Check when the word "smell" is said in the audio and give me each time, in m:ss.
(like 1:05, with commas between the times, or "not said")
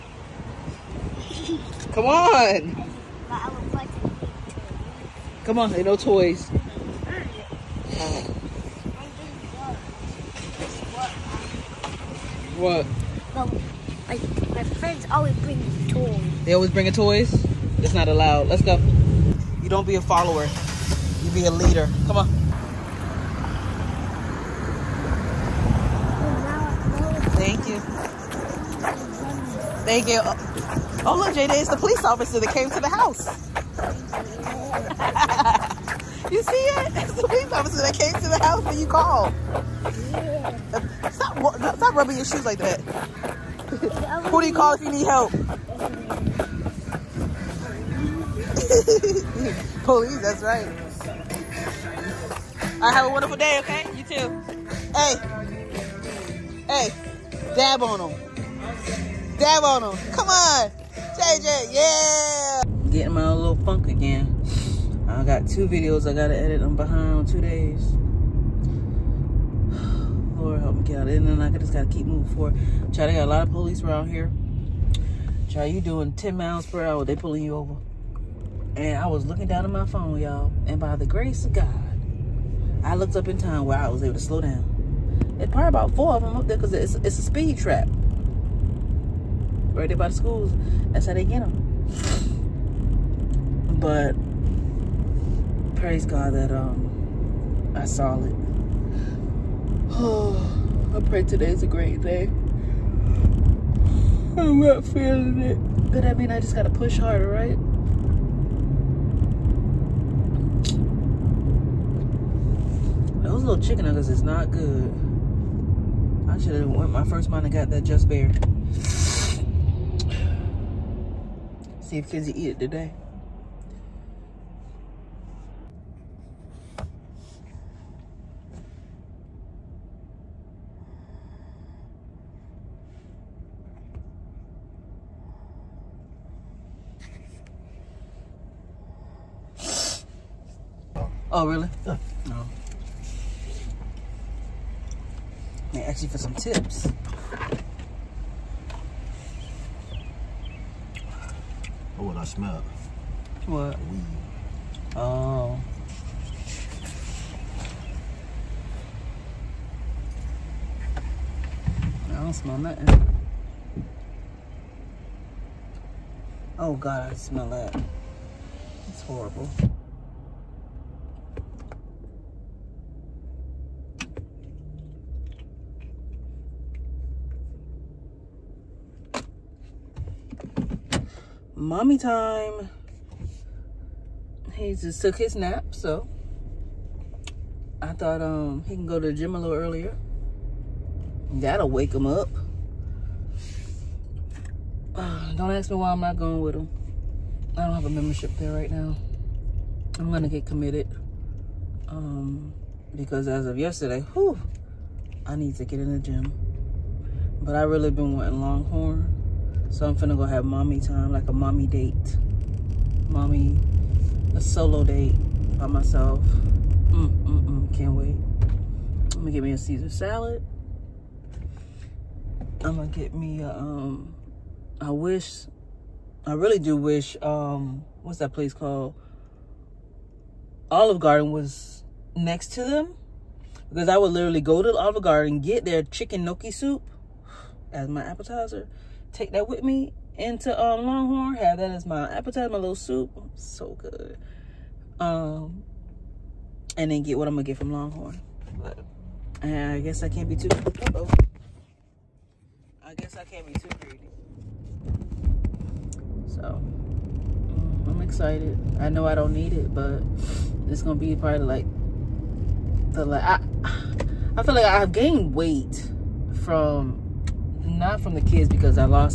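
2:32, 2:42, 2:47.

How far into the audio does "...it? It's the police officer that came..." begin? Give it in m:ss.
0:36.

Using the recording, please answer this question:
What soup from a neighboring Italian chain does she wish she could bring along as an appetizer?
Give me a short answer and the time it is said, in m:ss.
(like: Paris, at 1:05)
chicken gnocchi soup, at 3:55.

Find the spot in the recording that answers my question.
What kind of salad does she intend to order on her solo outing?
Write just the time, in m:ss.
3:39.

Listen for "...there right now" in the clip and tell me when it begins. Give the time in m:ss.
3:18.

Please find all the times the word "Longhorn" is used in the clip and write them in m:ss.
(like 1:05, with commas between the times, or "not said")
3:28, 4:00, 4:07.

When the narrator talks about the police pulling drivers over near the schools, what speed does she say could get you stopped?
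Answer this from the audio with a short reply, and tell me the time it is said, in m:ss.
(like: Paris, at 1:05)
10 miles per hour, at 1:16.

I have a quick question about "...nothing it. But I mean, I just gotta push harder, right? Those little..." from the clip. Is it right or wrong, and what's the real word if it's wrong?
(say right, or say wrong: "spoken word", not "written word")
wrong: "feeling", not "nothing".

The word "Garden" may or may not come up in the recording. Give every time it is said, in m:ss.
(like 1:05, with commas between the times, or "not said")
3:50, 3:55.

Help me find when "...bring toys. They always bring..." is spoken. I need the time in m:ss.
0:15.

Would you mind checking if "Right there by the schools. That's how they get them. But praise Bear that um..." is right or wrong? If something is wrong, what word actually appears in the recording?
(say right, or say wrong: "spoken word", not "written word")
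wrong: "God", not "Bear".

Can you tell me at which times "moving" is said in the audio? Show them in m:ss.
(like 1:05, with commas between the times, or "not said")
1:12.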